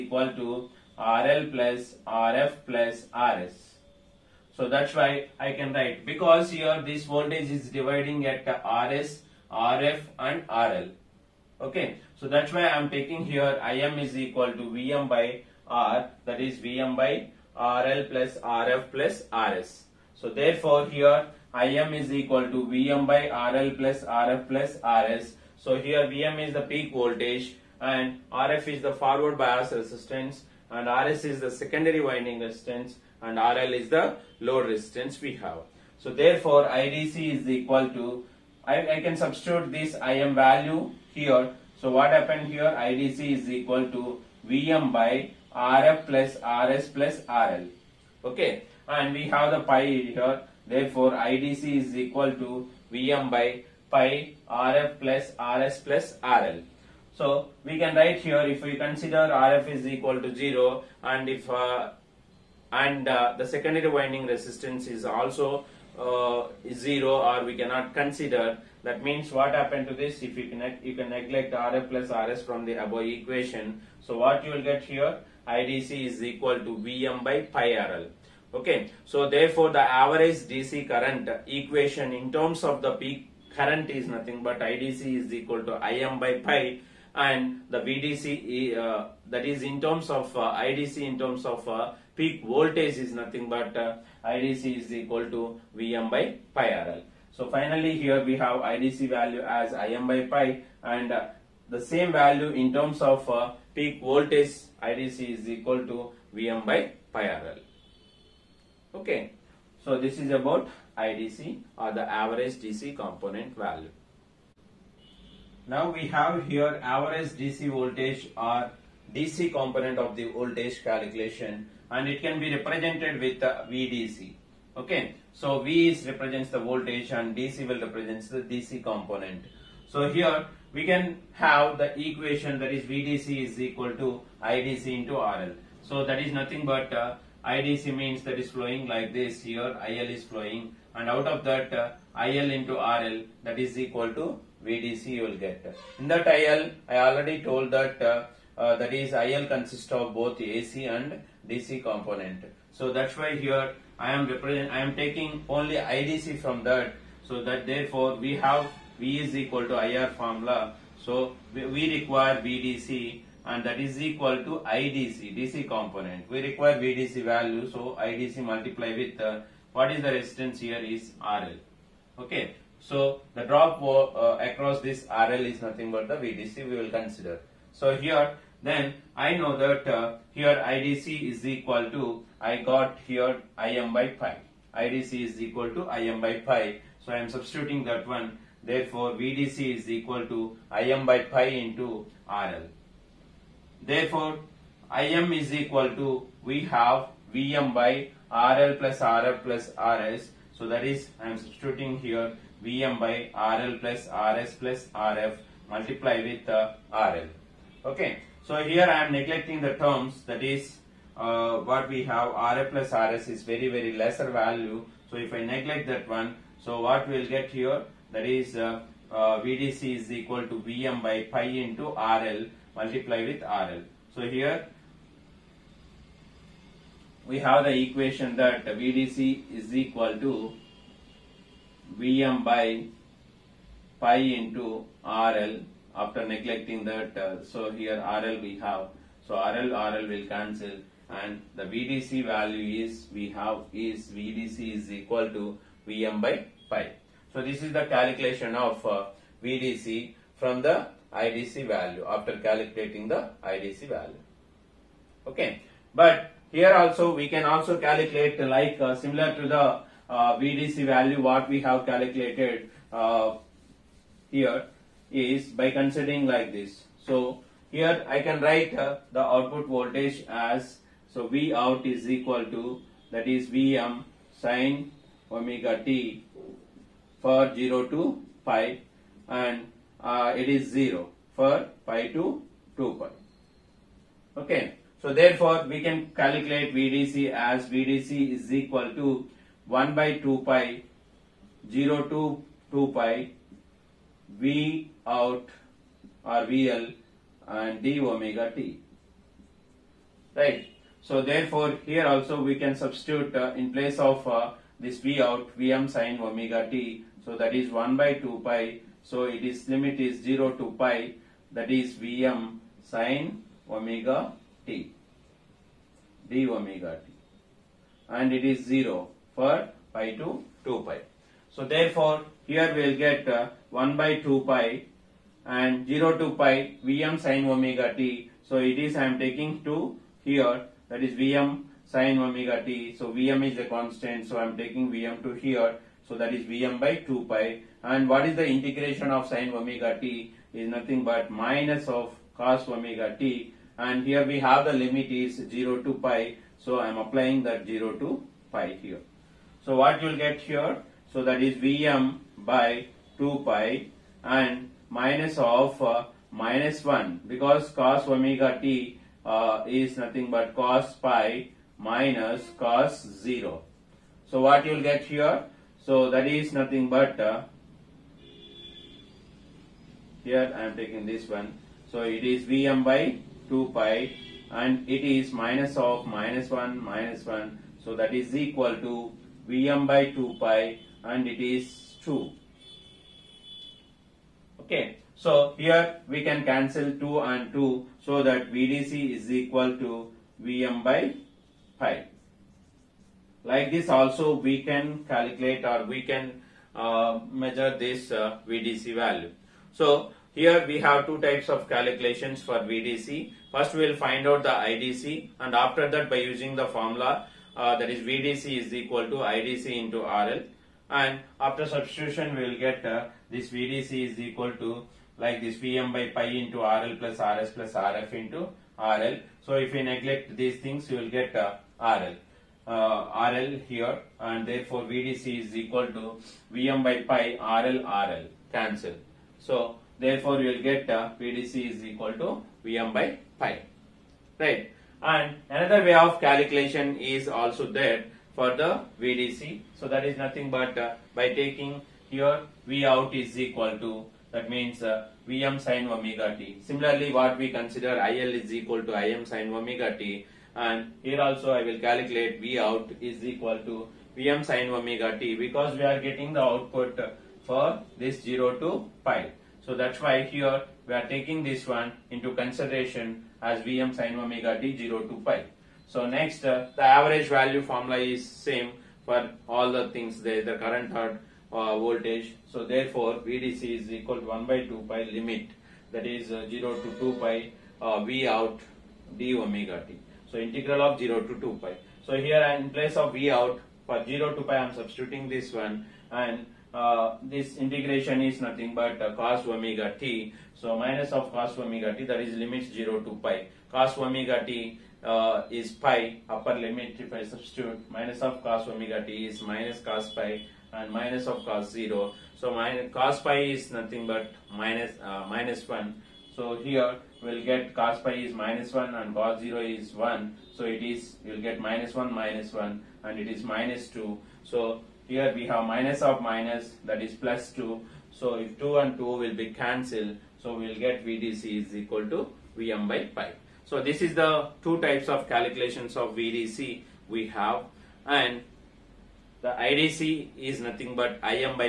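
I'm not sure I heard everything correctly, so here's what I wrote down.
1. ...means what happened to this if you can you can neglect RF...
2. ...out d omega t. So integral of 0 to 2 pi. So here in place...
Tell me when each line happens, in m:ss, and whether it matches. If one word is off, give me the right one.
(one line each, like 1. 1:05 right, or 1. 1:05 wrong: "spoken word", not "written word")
1. 1:09 right
2. 7:58 right.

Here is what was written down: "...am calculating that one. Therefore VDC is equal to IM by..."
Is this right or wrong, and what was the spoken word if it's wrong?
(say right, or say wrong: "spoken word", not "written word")
wrong: "substituting", not "calculating".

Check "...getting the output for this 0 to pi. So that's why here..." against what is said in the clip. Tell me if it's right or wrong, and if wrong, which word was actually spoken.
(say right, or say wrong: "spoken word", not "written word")
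right.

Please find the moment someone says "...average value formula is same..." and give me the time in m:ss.
7:46.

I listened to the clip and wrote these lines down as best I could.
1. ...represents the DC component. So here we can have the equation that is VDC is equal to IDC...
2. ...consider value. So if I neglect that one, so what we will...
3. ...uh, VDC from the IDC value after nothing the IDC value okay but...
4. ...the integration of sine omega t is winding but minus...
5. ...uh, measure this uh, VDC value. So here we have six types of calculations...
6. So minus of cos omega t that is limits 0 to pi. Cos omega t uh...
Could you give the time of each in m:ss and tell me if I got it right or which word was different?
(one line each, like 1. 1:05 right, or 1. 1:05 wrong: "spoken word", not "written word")
1. 2:07 right
2. 3:33 wrong: "lesser", not "consider"
3. 4:08 wrong: "calculating", not "nothing"
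4. 5:38 wrong: "nothing", not "winding"
5. 6:36 wrong: "two", not "six"
6. 8:10 right.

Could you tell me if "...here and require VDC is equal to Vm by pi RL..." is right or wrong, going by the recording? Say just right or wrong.
wrong.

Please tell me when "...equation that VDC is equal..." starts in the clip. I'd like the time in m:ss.
3:47.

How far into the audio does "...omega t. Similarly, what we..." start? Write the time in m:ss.
7:25.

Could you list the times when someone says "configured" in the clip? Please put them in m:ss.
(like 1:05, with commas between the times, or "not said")
not said.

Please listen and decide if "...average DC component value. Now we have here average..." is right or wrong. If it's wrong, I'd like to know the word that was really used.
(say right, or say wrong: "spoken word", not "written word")
right.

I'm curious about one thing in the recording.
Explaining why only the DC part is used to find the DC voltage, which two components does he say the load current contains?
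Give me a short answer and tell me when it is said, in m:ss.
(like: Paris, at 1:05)
AC and DC, at 2:30.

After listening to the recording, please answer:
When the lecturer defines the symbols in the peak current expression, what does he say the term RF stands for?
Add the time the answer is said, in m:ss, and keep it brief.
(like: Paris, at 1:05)
forward bias resistance, at 0:28.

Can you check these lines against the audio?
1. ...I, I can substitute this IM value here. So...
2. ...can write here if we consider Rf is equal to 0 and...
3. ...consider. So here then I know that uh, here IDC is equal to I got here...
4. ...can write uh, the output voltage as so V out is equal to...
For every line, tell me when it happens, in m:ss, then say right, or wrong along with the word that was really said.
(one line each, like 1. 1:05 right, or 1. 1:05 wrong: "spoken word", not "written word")
1. 0:38 right
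2. 0:57 right
3. 2:56 right
4. 4:28 right.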